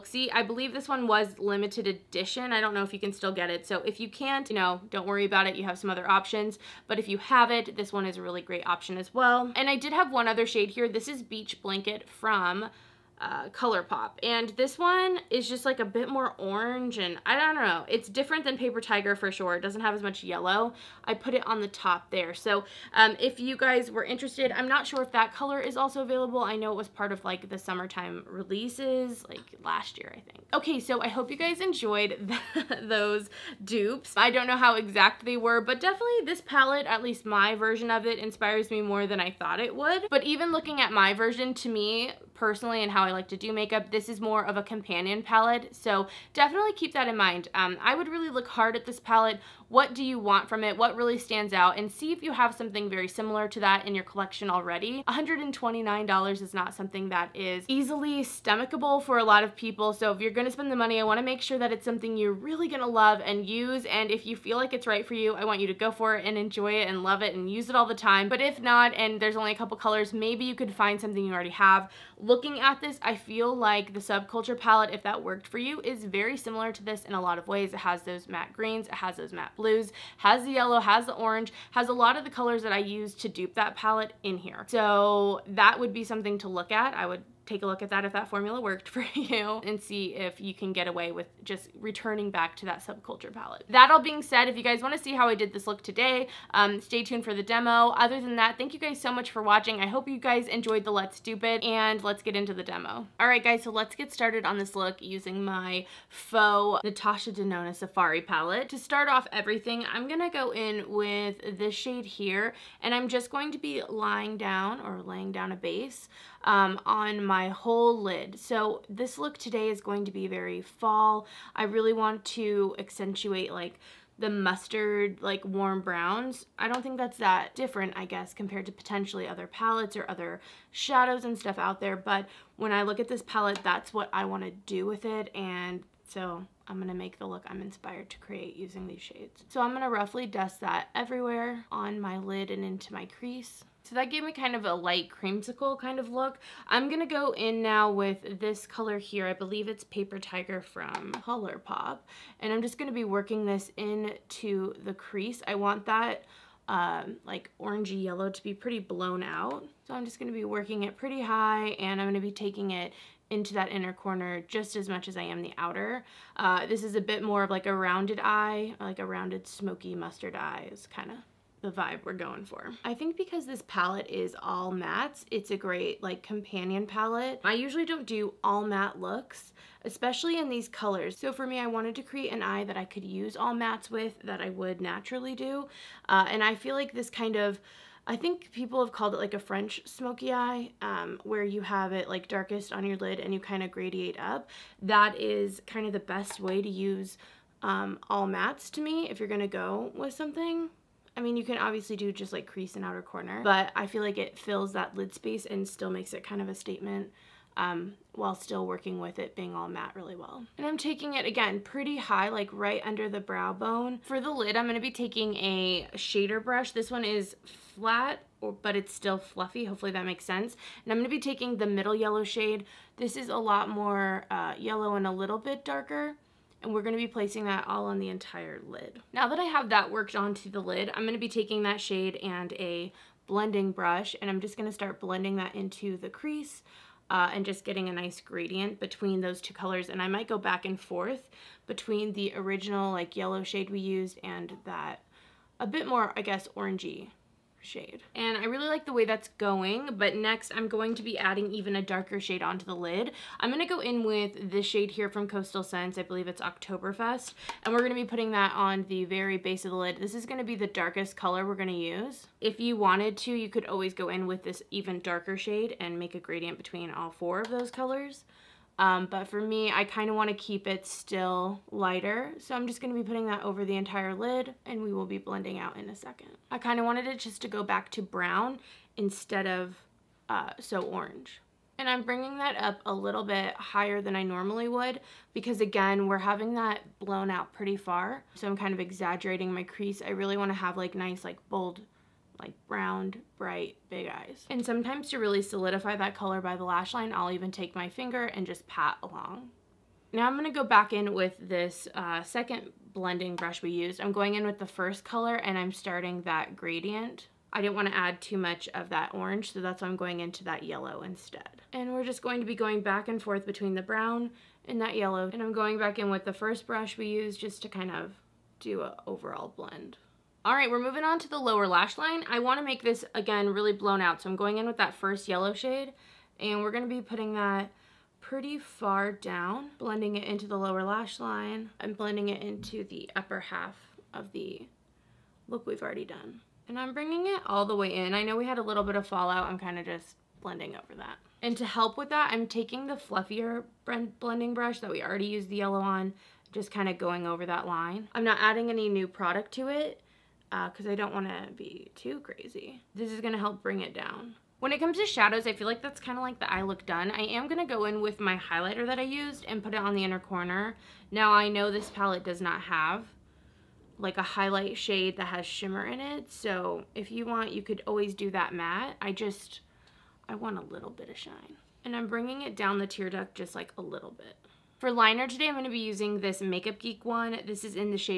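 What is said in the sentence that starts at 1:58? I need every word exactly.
So this look today is going to be very fall.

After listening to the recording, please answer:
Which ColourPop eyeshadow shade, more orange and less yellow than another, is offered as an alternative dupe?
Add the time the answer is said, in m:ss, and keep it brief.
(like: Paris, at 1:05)
Beach Blanket, at 0:11.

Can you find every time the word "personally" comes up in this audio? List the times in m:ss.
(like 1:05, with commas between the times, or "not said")
0:42.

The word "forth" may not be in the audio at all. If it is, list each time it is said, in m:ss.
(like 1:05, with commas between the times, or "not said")
4:00, 5:13.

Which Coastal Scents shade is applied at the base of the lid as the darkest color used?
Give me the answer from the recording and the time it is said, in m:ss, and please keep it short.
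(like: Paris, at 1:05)
Oktoberfest, at 4:16.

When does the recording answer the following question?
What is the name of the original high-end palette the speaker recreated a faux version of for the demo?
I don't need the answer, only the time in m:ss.
1:46.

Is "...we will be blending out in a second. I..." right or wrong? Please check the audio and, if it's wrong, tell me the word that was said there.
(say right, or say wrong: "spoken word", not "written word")
right.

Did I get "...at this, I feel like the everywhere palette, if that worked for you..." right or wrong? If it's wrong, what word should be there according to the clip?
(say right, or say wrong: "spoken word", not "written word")
wrong: "subculture", not "everywhere".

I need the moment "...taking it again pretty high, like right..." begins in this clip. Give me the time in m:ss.
3:30.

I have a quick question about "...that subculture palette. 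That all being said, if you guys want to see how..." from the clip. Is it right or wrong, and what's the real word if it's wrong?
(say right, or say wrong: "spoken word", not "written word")
right.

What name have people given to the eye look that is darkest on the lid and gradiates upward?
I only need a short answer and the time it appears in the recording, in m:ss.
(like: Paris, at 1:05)
French smoky eye, at 3:09.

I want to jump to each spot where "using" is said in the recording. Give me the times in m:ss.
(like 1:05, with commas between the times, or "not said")
1:44, 2:18, 6:15.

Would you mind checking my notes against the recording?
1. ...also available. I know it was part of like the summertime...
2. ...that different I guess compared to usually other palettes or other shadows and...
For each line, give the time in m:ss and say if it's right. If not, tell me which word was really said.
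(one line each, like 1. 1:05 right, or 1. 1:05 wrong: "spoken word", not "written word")
1. 0:25 right
2. 2:07 wrong: "potentially", not "usually".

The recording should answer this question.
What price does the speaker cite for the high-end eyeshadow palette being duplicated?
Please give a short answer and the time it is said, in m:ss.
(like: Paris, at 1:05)
$129, at 0:55.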